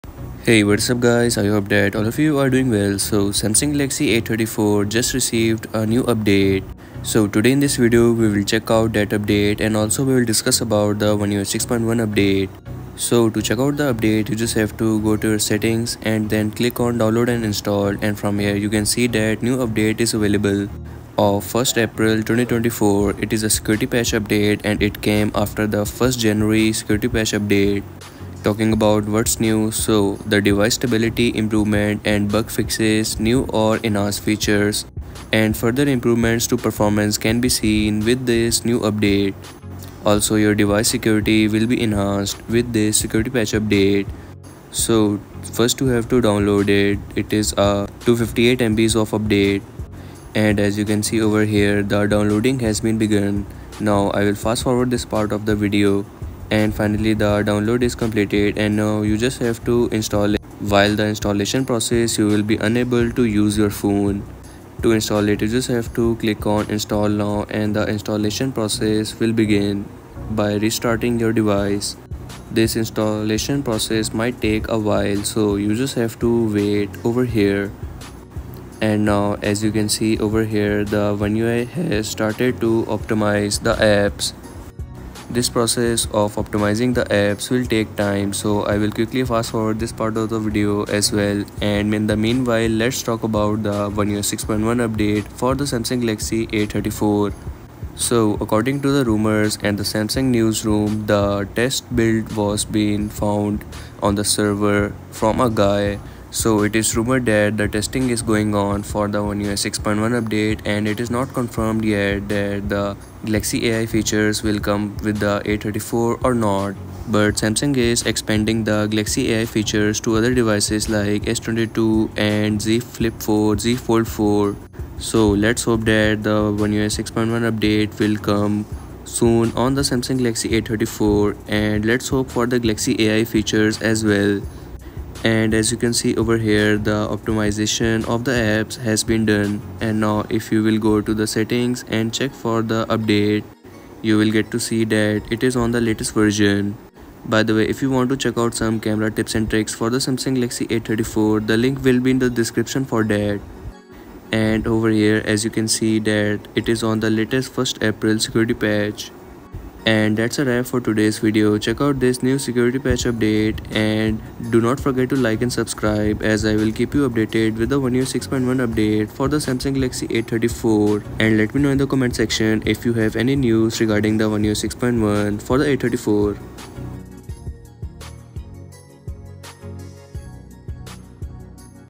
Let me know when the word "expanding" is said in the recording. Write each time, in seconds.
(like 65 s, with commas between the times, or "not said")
118 s.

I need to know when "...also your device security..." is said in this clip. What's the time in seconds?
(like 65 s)
40 s.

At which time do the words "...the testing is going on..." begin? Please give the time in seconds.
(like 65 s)
107 s.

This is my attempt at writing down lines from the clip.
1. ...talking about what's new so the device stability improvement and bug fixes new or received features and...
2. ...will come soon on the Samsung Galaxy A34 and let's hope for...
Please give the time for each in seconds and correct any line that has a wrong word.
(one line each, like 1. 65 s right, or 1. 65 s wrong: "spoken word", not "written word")
1. 28 s wrong: "enhanced", not "received"
2. 127 s right.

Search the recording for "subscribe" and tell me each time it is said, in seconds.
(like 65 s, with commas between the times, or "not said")
165 s.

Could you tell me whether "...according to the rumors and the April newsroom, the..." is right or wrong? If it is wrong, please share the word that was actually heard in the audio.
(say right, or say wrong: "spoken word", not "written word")
wrong: "Samsung", not "April".